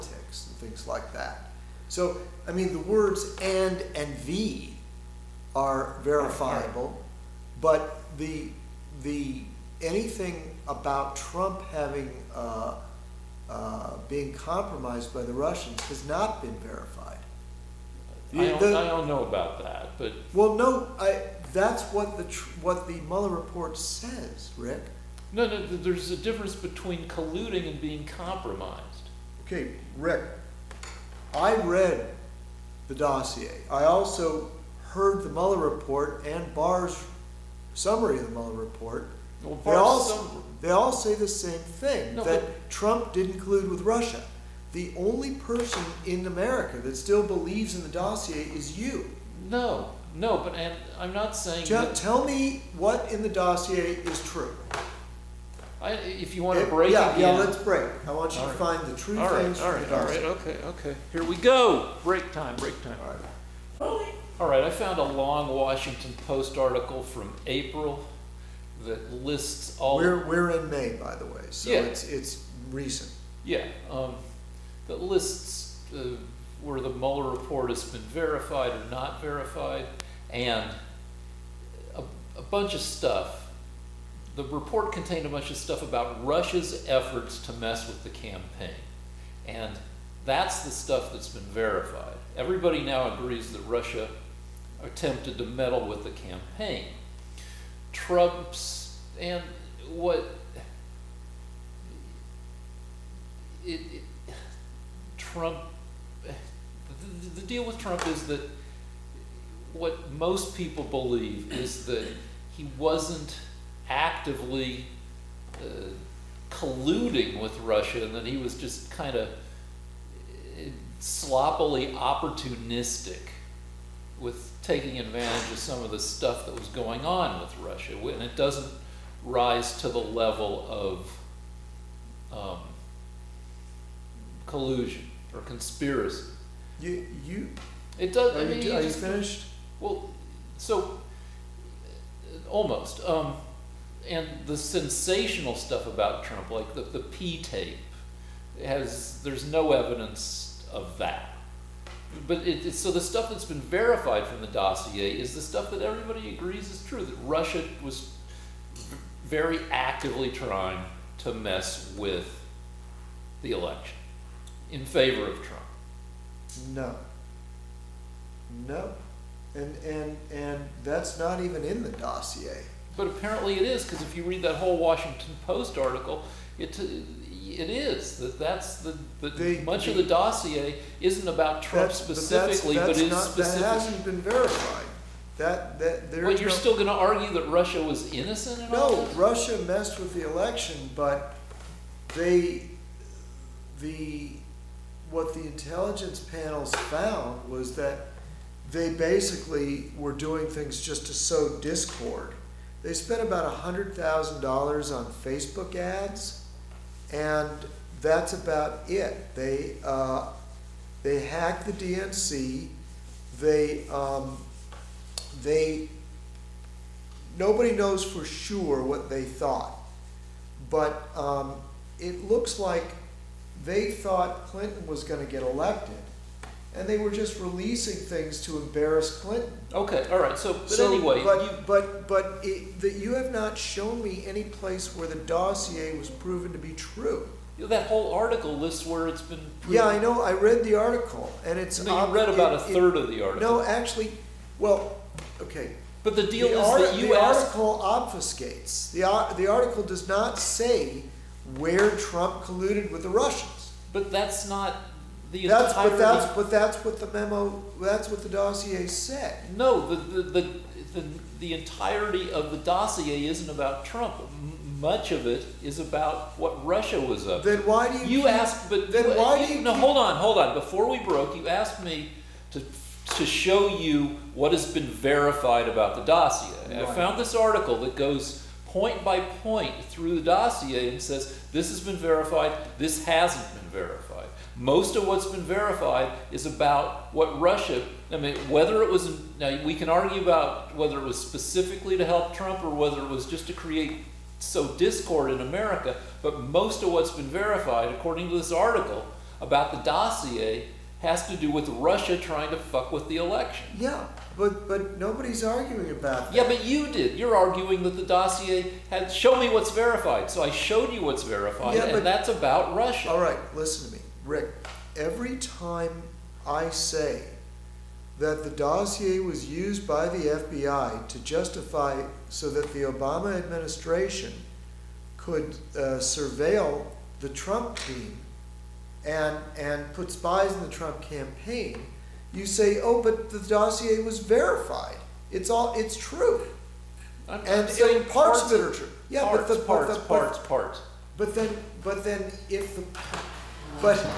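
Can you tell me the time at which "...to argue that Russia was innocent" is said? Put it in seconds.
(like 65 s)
186 s.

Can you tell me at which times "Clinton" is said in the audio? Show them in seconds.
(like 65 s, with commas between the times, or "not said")
224 s, 229 s.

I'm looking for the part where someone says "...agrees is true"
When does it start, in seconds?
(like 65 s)
156 s.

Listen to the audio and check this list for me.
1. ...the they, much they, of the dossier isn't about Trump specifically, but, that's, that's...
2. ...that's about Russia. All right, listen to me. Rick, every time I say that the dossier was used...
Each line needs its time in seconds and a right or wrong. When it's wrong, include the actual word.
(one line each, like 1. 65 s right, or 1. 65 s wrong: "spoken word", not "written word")
1. 179 s right
2. 312 s right.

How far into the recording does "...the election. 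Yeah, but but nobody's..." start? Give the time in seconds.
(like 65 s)
303 s.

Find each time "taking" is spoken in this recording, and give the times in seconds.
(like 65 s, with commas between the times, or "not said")
124 s.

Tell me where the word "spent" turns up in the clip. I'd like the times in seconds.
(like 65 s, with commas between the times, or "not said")
202 s.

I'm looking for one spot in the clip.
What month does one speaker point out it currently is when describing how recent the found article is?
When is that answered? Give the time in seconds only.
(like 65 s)
70 s.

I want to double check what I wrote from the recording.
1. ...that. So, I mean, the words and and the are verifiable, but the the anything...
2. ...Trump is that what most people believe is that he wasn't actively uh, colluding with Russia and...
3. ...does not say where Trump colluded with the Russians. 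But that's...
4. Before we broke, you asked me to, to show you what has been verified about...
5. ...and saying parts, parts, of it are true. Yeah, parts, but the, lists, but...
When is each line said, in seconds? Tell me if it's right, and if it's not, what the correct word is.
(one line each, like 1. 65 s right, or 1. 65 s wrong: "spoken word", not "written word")
1. 1 s right
2. 107 s right
3. 249 s right
4. 270 s right
5. 337 s wrong: "parts", not "lists".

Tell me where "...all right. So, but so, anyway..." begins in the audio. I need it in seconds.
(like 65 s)
230 s.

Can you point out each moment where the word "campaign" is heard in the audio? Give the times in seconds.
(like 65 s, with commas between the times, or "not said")
88 s, 96 s, 331 s.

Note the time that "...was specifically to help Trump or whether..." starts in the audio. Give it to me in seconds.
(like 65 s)
291 s.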